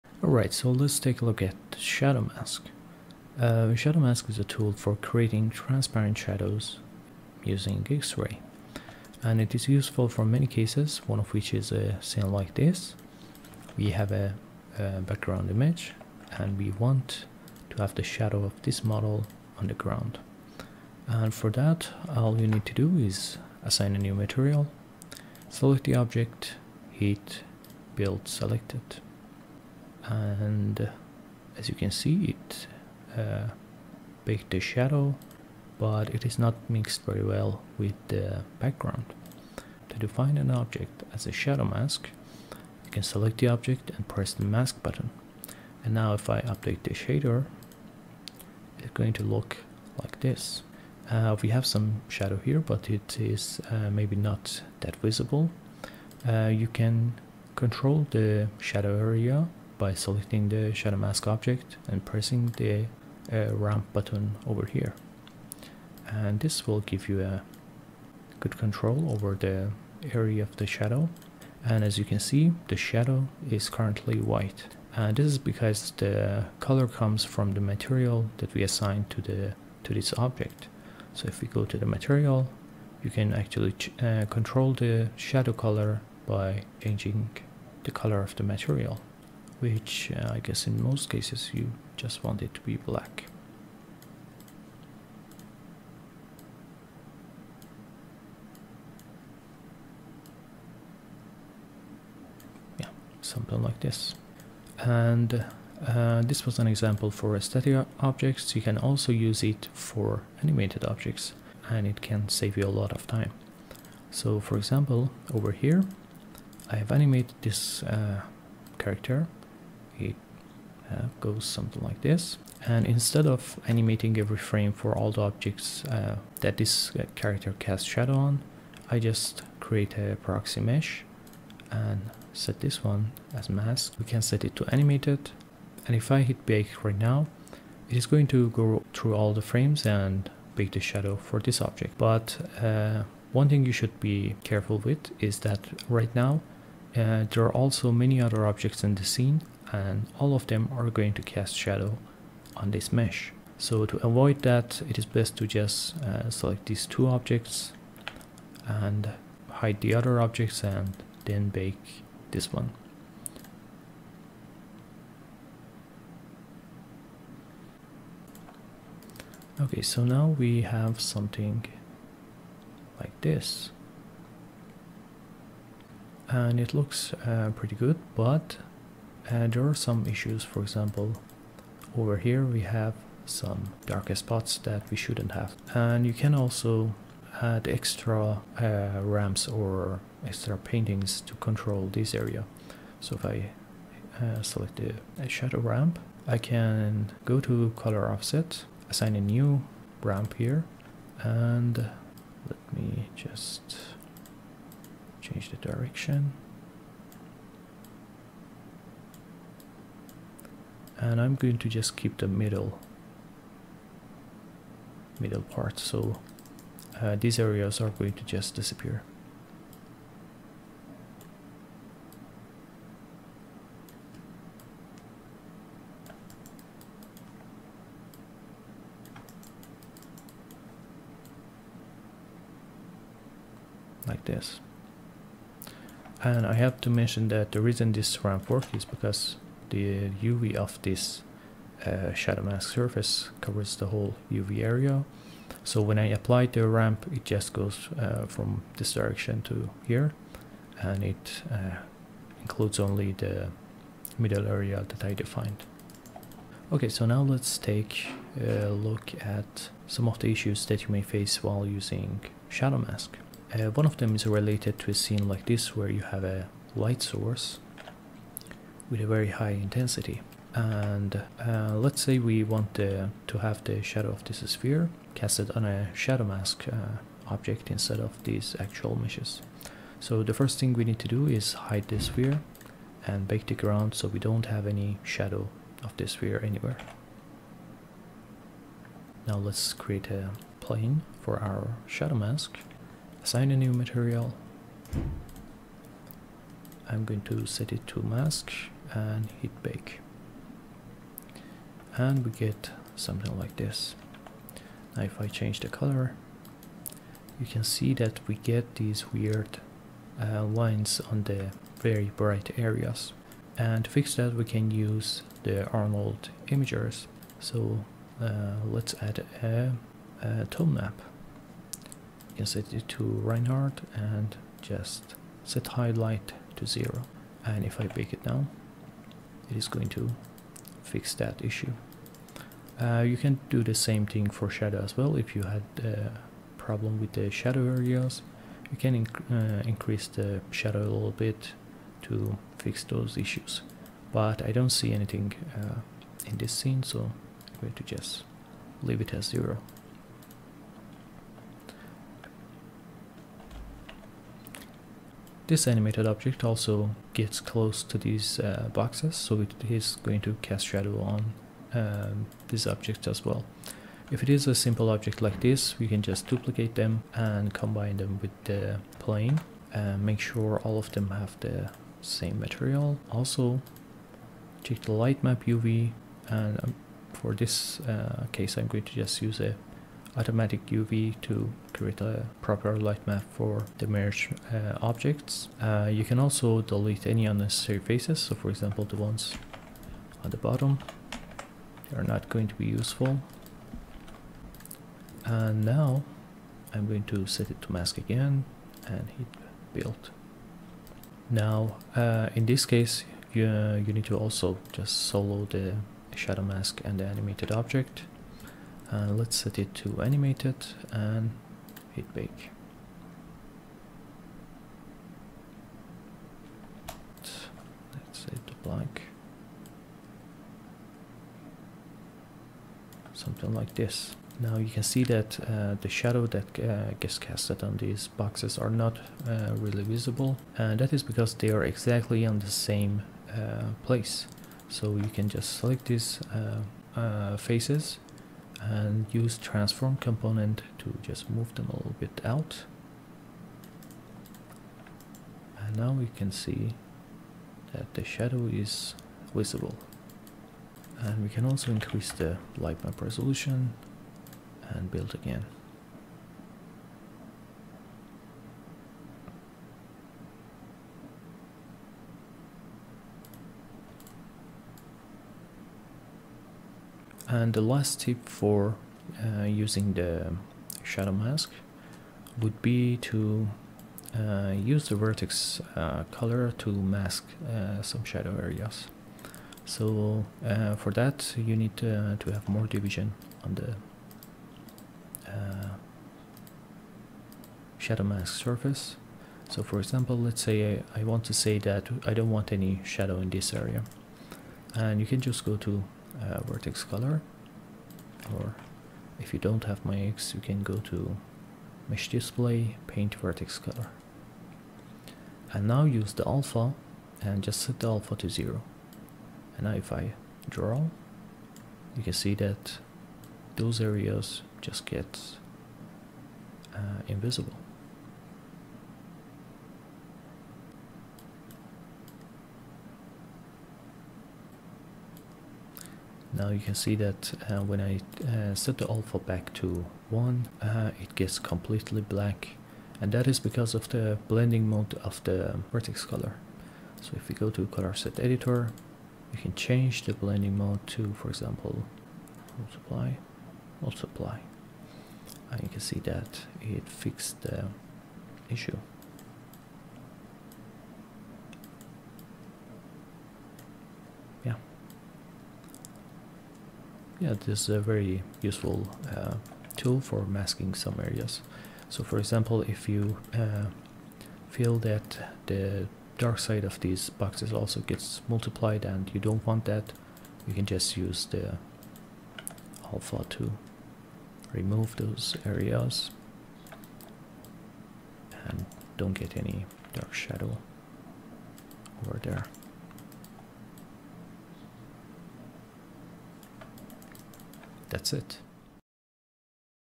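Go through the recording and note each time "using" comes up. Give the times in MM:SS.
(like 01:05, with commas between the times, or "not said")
00:07, 04:21, 07:49.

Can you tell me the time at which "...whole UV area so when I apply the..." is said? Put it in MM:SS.
04:03.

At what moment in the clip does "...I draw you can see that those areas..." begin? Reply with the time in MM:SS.
08:29.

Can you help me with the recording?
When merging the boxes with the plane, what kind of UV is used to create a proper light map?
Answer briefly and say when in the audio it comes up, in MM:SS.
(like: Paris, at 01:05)
automatic UV, at 06:20.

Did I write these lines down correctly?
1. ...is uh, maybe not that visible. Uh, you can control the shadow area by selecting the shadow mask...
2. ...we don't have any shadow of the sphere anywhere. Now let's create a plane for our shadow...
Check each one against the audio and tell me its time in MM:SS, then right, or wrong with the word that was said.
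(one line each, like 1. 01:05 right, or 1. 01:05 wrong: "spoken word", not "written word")
1. 00:53 right
2. 04:44 right.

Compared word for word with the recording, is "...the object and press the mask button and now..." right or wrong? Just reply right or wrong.
right.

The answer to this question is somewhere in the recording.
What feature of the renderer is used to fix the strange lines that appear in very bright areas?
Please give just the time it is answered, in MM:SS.
05:15.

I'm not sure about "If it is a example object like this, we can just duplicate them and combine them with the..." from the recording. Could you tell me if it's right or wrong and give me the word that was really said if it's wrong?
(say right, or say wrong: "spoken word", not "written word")
wrong: "simple", not "example".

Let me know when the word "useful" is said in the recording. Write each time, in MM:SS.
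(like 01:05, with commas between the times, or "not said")
00:09, 06:32, 09:18.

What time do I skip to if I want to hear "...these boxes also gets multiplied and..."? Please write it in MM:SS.
09:26.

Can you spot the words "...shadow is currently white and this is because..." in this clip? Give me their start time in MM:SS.
01:12.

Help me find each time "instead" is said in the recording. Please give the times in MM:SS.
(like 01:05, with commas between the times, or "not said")
02:02, 04:37.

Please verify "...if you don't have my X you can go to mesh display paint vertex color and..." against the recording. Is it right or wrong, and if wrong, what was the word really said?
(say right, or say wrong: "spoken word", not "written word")
right.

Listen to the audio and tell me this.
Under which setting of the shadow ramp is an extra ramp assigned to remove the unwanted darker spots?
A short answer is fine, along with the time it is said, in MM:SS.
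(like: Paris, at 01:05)
color offset, at 03:17.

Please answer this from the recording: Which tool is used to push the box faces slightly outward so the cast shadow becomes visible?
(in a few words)
transform component.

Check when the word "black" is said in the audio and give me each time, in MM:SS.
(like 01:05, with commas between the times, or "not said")
01:32, 08:52.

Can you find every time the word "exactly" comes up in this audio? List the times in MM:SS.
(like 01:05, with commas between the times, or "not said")
07:11.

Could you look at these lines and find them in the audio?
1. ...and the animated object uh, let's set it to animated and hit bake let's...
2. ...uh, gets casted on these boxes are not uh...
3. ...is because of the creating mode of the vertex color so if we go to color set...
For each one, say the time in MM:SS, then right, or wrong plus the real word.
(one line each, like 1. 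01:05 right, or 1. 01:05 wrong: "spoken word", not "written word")
1. 06:46 right
2. 07:06 right
3. 08:53 wrong: "blending", not "creating".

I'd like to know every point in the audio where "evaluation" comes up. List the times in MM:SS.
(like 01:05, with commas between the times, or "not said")
not said.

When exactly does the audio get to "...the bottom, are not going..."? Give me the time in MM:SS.
06:30.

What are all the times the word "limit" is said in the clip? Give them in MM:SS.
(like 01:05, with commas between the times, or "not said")
not said.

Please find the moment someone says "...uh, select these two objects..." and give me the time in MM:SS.
02:36.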